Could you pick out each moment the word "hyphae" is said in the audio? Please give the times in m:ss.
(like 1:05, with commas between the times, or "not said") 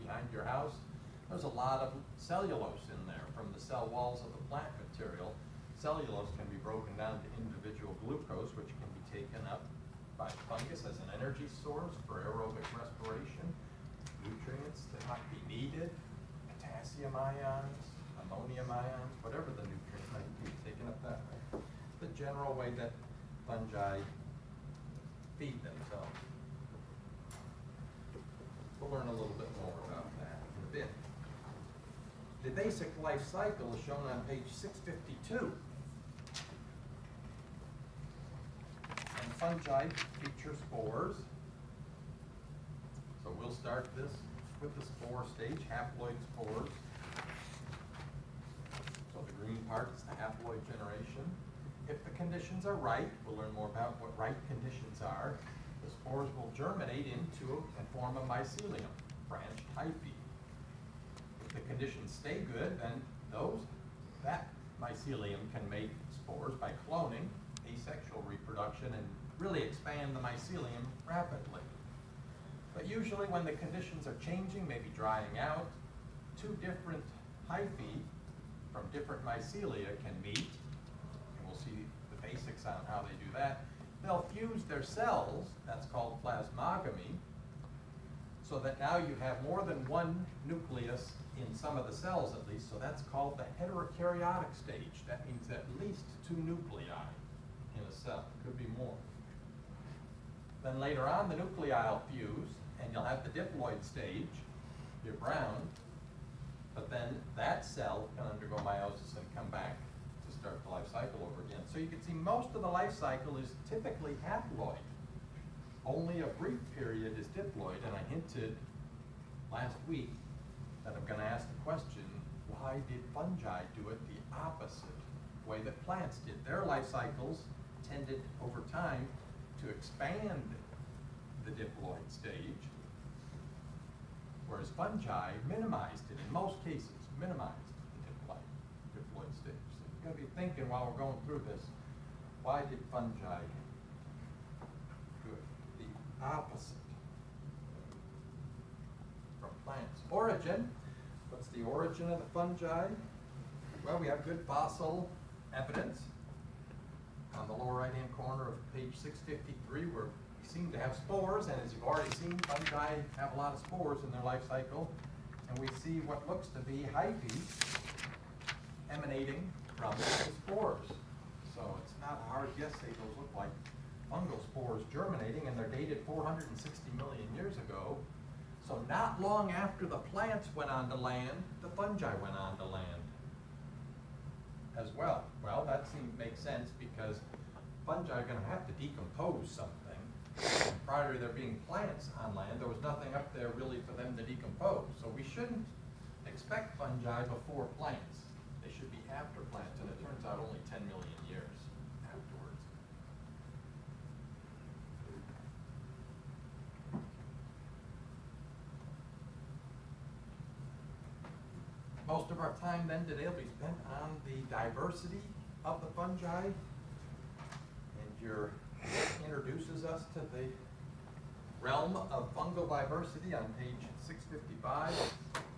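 0:59, 1:17, 2:46.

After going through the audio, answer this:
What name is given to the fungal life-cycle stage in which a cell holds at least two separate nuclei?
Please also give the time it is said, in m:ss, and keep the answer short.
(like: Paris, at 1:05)
Heterokaryotic stage, at 1:33.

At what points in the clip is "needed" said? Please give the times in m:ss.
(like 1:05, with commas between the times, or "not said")
0:15.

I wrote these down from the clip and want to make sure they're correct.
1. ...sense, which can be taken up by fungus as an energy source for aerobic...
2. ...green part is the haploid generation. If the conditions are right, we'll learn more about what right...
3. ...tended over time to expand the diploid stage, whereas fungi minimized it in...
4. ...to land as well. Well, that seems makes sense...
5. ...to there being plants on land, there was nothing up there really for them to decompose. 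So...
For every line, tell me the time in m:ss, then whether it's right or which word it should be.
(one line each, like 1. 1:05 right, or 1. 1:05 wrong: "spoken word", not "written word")
1. 0:08 wrong: "glucose", not "sense"
2. 0:49 right
3. 2:07 right
4. 3:02 right
5. 3:11 right.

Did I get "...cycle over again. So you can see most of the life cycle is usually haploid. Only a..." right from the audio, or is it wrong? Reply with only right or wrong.
wrong.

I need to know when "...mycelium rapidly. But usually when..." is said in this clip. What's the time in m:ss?
1:10.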